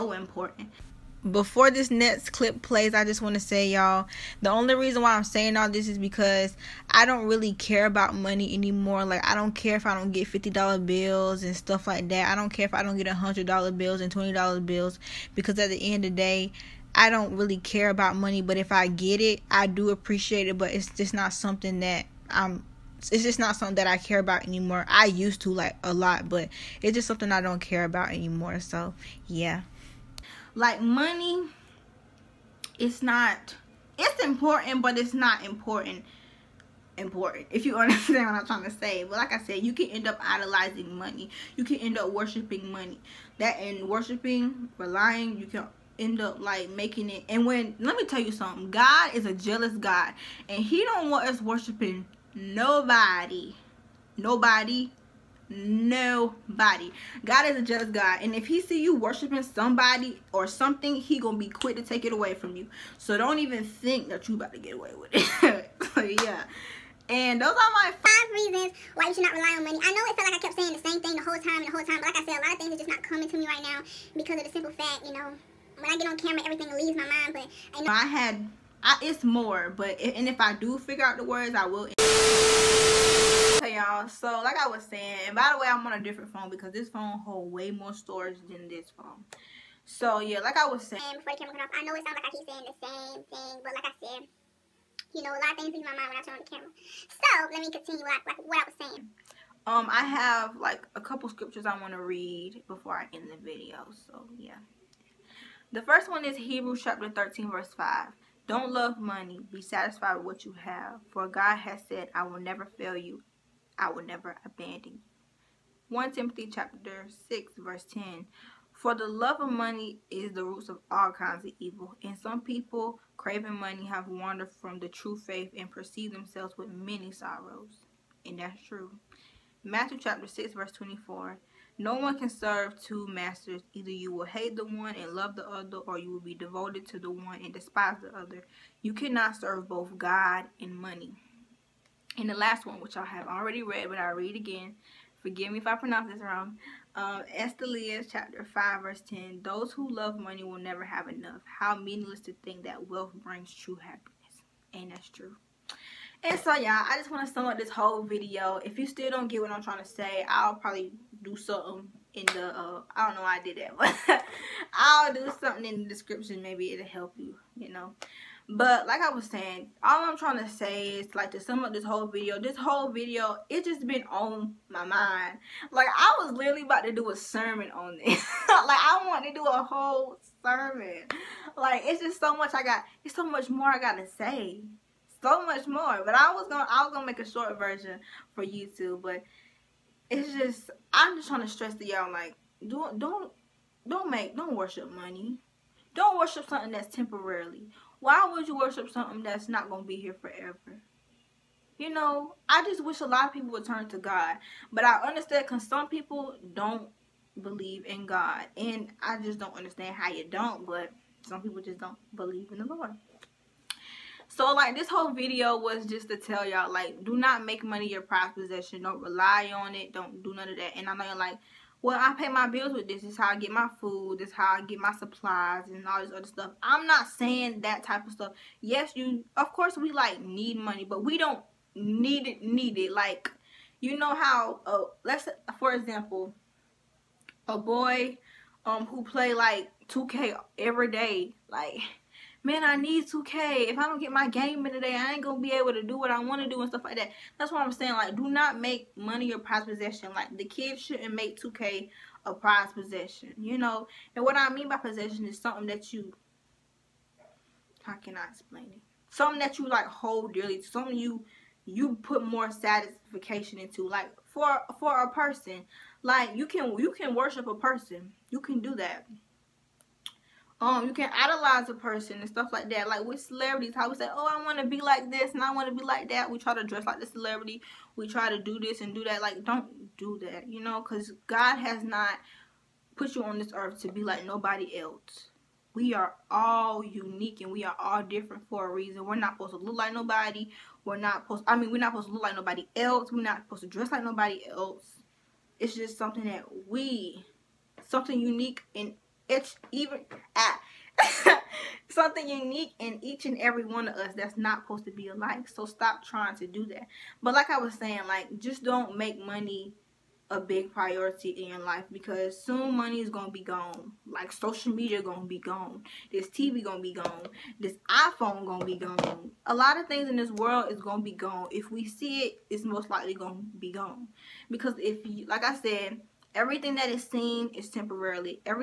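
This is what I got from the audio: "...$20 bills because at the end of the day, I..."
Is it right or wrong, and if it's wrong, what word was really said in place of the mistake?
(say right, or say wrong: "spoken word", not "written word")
right.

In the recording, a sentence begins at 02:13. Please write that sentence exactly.
Either you will hate the one and love the other, or you will be devoted to the one and despise the other.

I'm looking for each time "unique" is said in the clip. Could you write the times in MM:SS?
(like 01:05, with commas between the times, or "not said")
04:46, 04:58, 05:02.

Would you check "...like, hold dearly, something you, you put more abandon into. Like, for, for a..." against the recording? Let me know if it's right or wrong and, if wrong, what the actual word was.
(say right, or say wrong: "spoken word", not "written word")
wrong: "satisfaction", not "abandon".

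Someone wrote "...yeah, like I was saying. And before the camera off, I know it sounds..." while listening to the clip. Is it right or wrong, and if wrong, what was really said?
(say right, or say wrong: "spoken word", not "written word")
right.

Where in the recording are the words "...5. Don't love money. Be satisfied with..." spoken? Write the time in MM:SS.
01:47.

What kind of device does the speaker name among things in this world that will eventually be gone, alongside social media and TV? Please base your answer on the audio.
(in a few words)
iPhone.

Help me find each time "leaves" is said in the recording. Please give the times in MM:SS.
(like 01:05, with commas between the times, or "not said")
01:16, 01:35.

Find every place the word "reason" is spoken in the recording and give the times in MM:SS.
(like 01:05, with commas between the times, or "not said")
00:04, 01:08, 04:48.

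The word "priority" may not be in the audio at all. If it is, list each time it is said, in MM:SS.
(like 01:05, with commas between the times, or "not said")
05:10.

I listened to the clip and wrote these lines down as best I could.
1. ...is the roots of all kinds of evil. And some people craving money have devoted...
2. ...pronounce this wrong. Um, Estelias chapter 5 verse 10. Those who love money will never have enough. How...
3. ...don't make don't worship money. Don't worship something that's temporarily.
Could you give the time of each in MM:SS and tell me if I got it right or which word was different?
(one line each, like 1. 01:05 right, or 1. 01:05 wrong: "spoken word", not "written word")
1. 02:00 wrong: "wandered", not "devoted"
2. 02:25 right
3. 03:13 right.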